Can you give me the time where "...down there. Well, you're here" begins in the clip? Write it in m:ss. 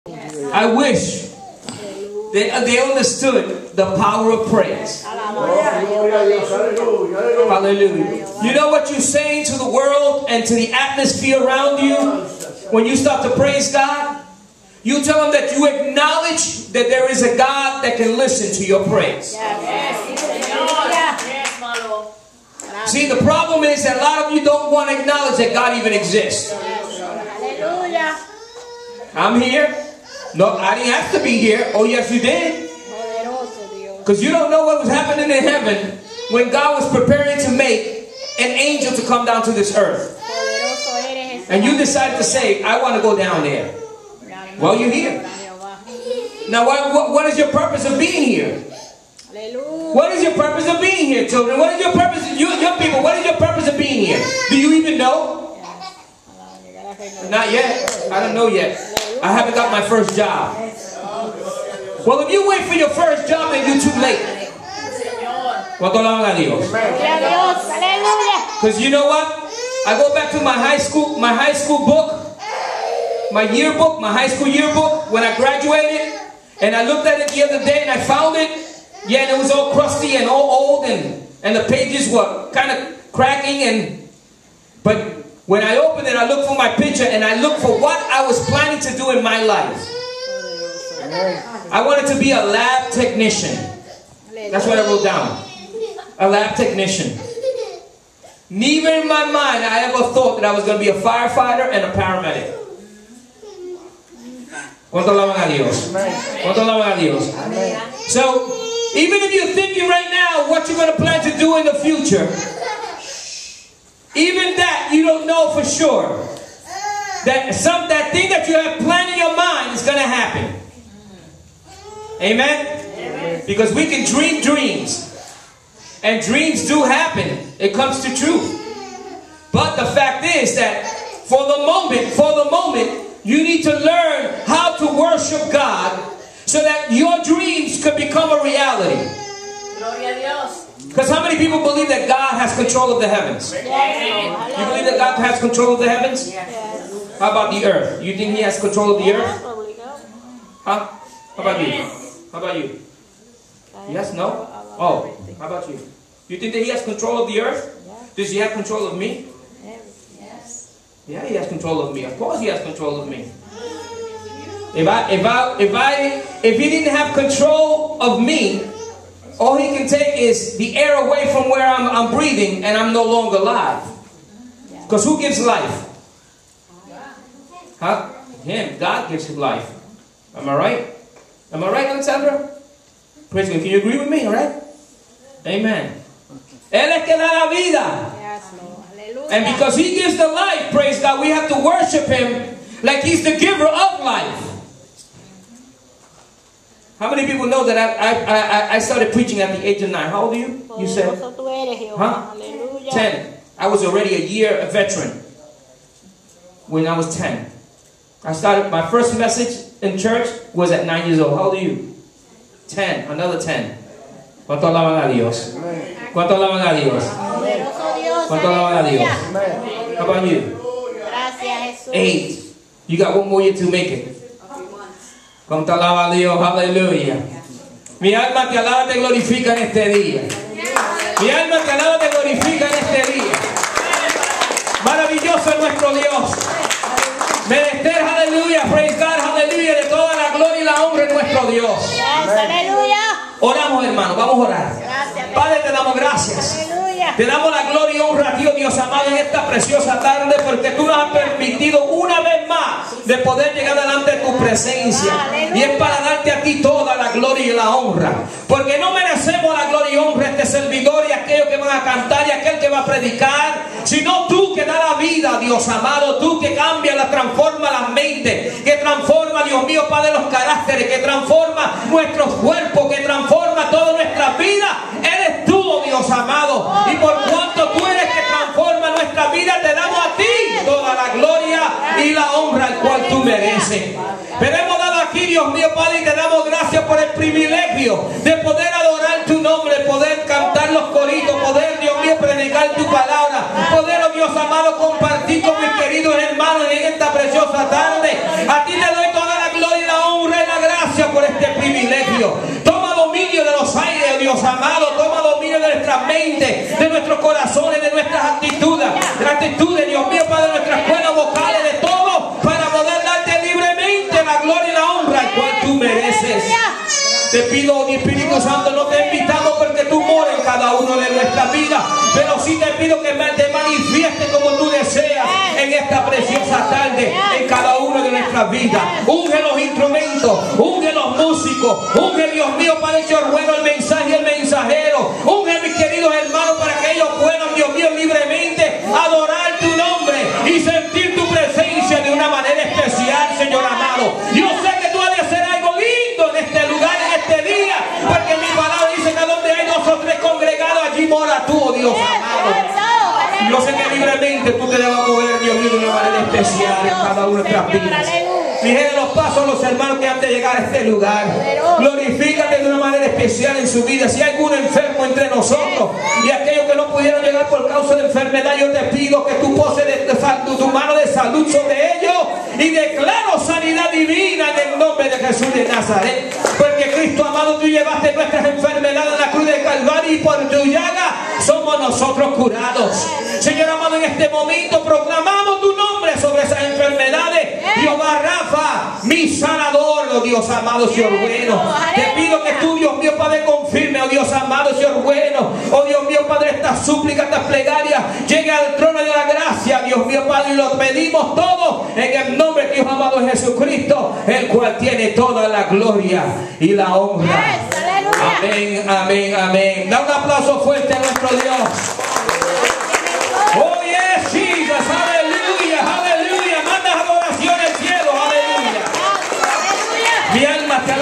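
0:43.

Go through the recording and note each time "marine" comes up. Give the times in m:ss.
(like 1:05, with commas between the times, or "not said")
not said.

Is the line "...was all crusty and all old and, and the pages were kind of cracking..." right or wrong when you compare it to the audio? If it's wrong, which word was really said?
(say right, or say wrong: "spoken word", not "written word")
right.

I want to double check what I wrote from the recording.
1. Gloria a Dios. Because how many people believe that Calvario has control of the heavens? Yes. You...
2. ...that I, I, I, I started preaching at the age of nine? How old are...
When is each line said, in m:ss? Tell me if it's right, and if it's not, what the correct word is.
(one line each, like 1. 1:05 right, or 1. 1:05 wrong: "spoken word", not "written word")
1. 2:19 wrong: "God", not "Calvario"
2. 3:17 right.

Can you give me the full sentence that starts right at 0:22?
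See, the problem is that a lot of you don't want to acknowledge that God even exists.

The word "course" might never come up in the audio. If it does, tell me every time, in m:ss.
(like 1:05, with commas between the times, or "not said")
2:42.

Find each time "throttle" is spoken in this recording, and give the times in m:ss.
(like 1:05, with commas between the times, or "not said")
not said.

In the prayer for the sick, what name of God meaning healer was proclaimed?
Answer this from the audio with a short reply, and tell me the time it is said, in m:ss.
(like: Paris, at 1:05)
Rafa, at 6:28.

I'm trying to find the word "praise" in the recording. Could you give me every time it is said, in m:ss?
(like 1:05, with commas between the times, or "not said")
0:04, 0:13, 0:18, 3:03, 3:10, 3:58.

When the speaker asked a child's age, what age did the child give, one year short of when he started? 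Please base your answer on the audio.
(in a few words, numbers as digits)
8.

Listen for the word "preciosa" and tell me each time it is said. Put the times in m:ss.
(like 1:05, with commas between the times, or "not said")
4:09, 4:57, 5:26.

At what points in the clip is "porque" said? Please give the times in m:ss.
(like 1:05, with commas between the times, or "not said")
4:10, 4:18, 5:19, 6:16.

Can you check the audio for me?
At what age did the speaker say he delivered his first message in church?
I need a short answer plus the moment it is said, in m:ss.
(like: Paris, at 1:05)
9, at 3:30.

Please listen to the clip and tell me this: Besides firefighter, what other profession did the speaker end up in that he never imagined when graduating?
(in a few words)
paramedic.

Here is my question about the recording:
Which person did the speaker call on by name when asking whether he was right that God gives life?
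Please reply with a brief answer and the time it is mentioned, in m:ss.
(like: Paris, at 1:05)
Alexandra, at 3:01.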